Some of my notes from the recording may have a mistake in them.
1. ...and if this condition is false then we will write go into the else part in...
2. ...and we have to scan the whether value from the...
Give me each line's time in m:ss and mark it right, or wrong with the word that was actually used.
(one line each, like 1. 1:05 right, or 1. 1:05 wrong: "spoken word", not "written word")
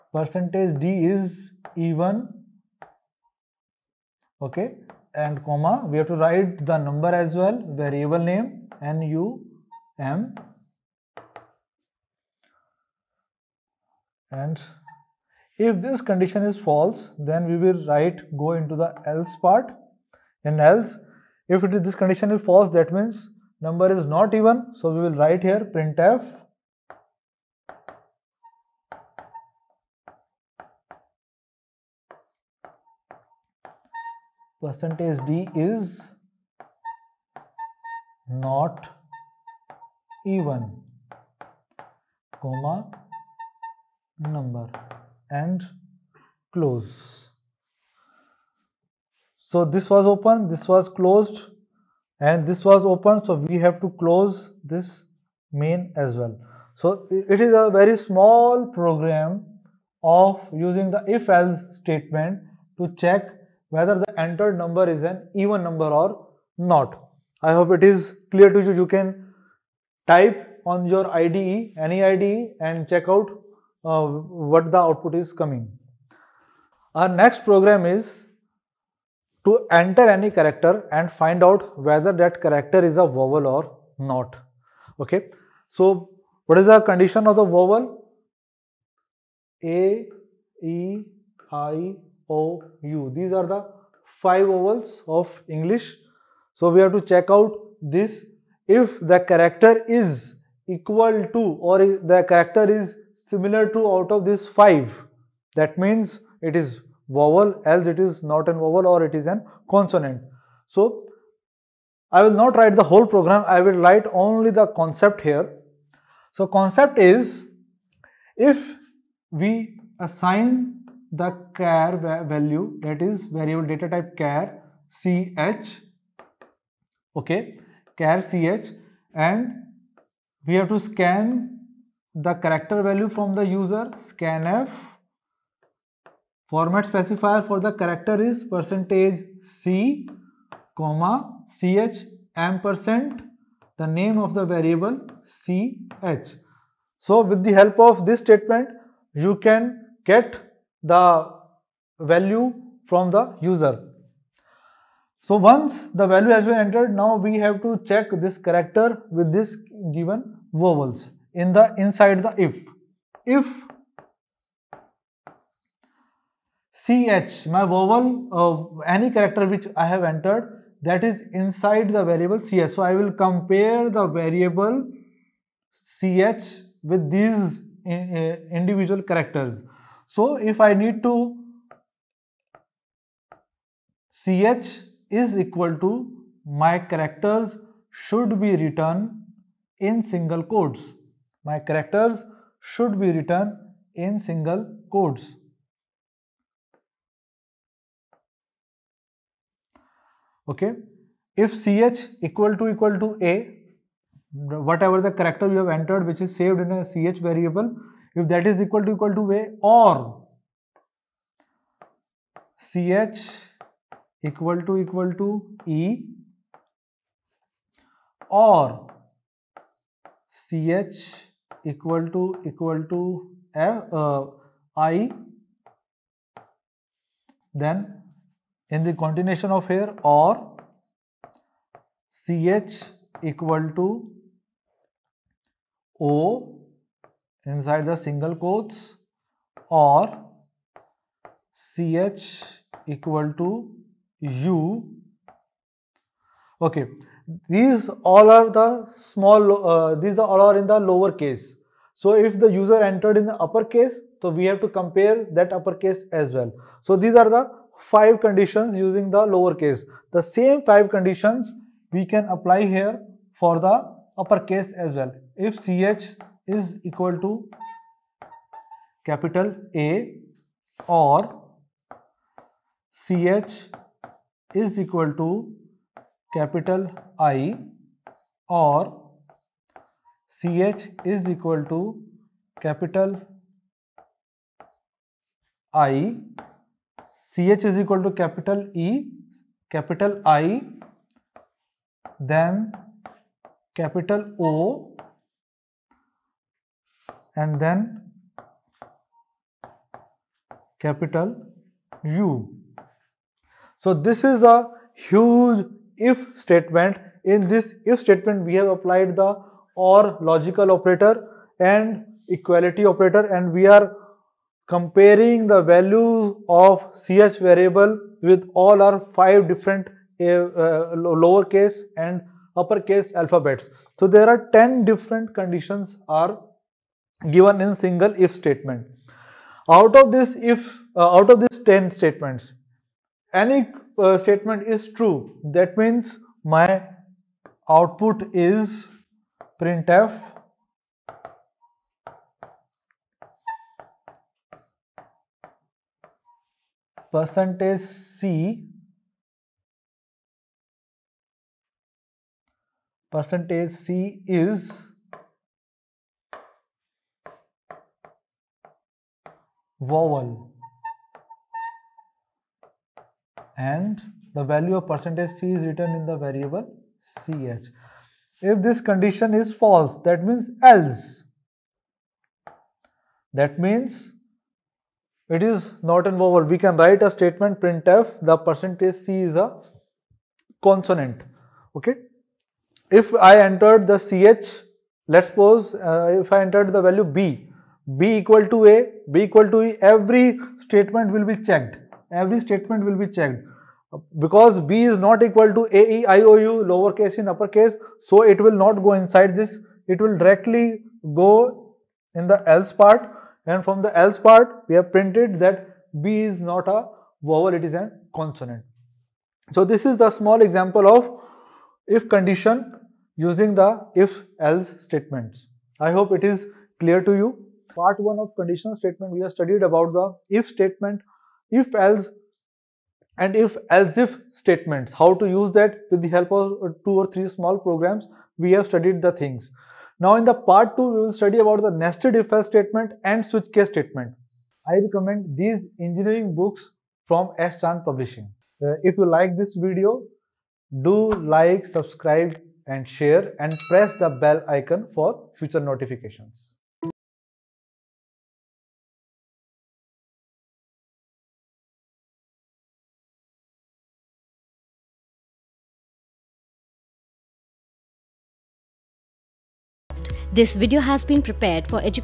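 1. 0:14 right
2. 2:09 wrong: "character", not "whether".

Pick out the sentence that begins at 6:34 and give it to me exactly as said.
Because B is not equal to A, E, I, O, U, lowercase in uppercase, so it will not go inside this.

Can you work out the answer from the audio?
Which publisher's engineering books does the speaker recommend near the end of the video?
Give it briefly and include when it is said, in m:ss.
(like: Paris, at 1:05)
S Chand Publishing, at 7:17.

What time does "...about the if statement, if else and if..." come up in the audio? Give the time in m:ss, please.
6:59.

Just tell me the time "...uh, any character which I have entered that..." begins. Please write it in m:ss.
2:48.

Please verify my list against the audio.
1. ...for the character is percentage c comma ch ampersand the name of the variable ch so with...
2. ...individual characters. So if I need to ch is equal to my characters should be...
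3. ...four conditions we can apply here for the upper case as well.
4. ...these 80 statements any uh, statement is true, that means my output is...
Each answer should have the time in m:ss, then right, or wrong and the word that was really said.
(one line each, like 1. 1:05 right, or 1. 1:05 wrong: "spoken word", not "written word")
1. 2:17 right
2. 2:58 right
3. 4:20 wrong: "five", not "four"
4. 5:31 wrong: "10", not "80".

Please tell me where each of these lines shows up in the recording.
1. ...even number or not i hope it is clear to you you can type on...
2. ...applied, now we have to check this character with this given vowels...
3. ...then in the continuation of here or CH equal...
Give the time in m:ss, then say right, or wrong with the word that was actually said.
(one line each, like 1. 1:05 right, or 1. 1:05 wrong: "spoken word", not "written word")
1. 1:05 right
2. 2:36 wrong: "entered", not "applied"
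3. 3:47 right.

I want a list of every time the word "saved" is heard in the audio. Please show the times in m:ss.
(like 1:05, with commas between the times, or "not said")
3:26.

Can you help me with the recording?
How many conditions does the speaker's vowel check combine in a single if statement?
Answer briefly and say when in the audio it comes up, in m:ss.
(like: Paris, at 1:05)
10, at 5:24.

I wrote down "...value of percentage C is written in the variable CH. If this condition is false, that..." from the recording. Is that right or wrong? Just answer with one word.
right.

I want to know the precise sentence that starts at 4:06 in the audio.
Okay, these all are the small, uh, these are all are in the lower case.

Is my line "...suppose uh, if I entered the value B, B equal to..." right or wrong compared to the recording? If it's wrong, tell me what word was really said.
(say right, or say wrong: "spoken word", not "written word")
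right.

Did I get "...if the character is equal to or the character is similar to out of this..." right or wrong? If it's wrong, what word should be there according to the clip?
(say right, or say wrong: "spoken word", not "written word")
right.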